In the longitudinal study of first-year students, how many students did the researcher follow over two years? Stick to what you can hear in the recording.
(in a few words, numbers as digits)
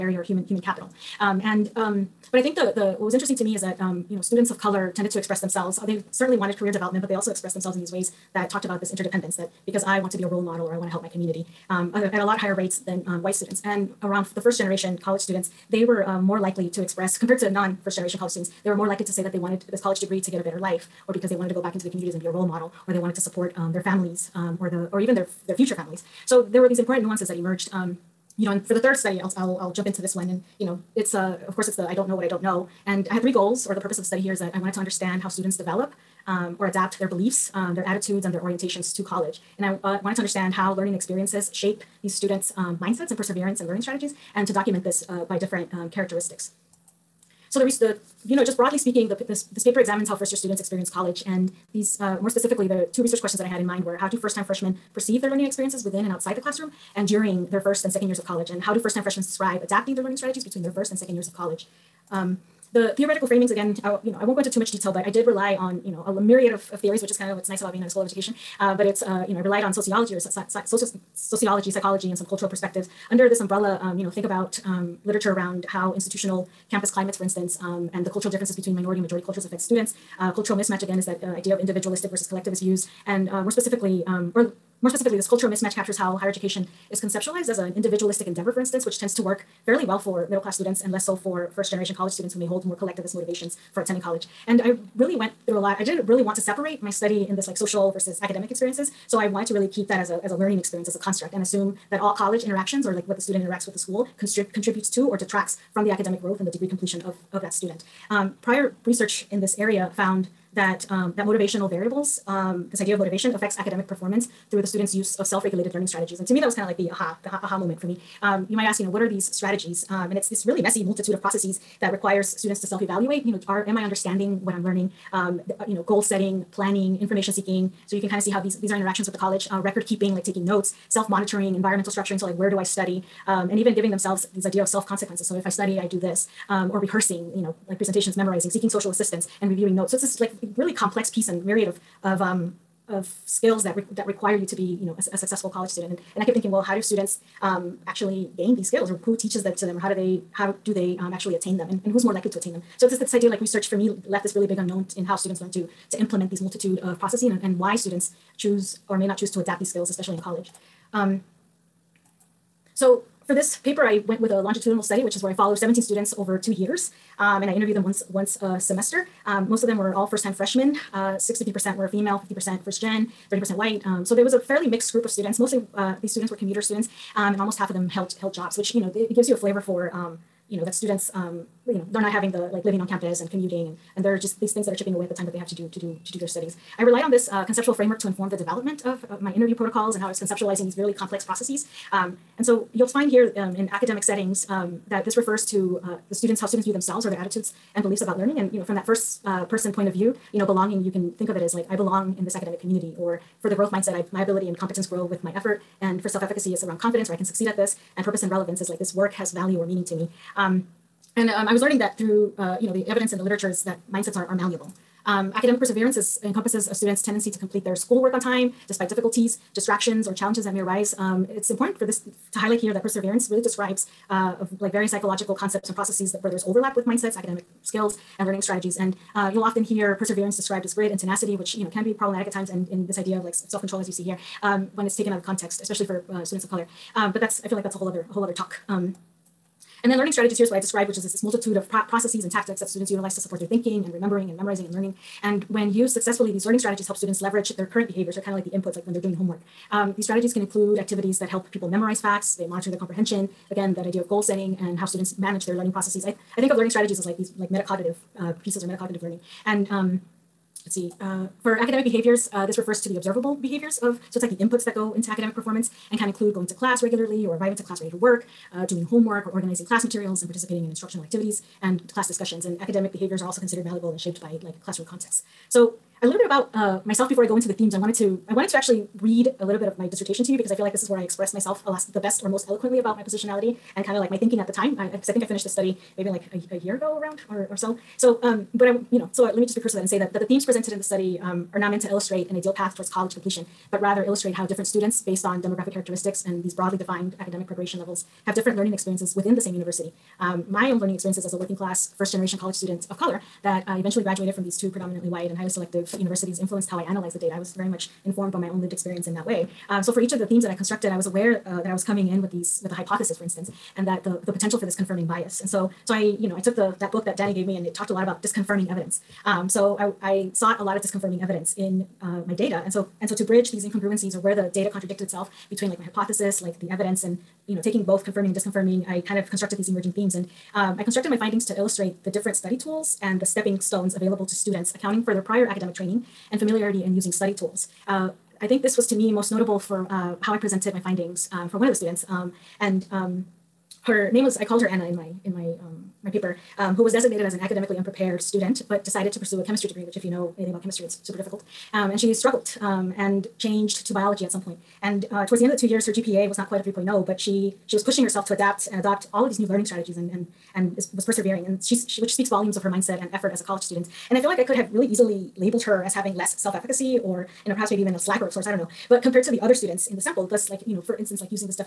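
17.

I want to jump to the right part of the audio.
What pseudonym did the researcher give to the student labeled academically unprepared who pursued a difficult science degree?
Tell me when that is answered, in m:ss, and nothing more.
5:44.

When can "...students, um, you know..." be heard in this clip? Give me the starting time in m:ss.
3:00.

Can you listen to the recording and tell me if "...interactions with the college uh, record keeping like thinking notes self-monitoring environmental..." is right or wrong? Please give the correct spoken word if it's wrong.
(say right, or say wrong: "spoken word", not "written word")
wrong: "taking", not "thinking".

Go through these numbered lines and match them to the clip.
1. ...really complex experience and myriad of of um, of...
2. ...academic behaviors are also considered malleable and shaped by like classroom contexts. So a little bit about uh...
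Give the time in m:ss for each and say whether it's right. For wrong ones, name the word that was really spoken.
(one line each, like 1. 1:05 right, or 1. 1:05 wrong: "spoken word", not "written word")
1. 2:20 wrong: "piece", not "experience"
2. 4:32 right.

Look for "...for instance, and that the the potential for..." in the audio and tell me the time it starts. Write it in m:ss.
5:13.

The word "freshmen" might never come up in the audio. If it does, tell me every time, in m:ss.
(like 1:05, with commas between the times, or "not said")
0:54, 0:59, 2:50.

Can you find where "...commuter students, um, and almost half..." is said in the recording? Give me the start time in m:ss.
2:56.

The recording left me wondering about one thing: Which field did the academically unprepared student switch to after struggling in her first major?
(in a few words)
Biology.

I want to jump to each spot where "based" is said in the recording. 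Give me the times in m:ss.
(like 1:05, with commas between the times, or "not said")
4:55.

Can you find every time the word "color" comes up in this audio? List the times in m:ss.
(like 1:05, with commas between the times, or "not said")
0:04, 3:56, 5:02.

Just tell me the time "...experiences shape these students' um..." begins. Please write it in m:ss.
0:40.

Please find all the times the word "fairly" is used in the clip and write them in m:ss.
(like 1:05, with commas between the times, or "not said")
1:29, 2:54.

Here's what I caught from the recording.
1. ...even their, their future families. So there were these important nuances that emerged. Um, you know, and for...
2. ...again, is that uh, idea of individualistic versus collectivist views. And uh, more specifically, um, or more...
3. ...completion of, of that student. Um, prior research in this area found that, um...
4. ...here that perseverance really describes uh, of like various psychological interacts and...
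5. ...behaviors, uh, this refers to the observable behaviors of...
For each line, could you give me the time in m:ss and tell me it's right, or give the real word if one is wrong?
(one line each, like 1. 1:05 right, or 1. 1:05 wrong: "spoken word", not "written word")
1. 0:25 right
2. 1:20 right
3. 1:46 right
4. 3:42 wrong: "concepts", not "interacts"
5. 4:21 right.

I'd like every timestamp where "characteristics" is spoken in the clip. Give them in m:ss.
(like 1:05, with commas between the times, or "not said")
0:45, 4:55.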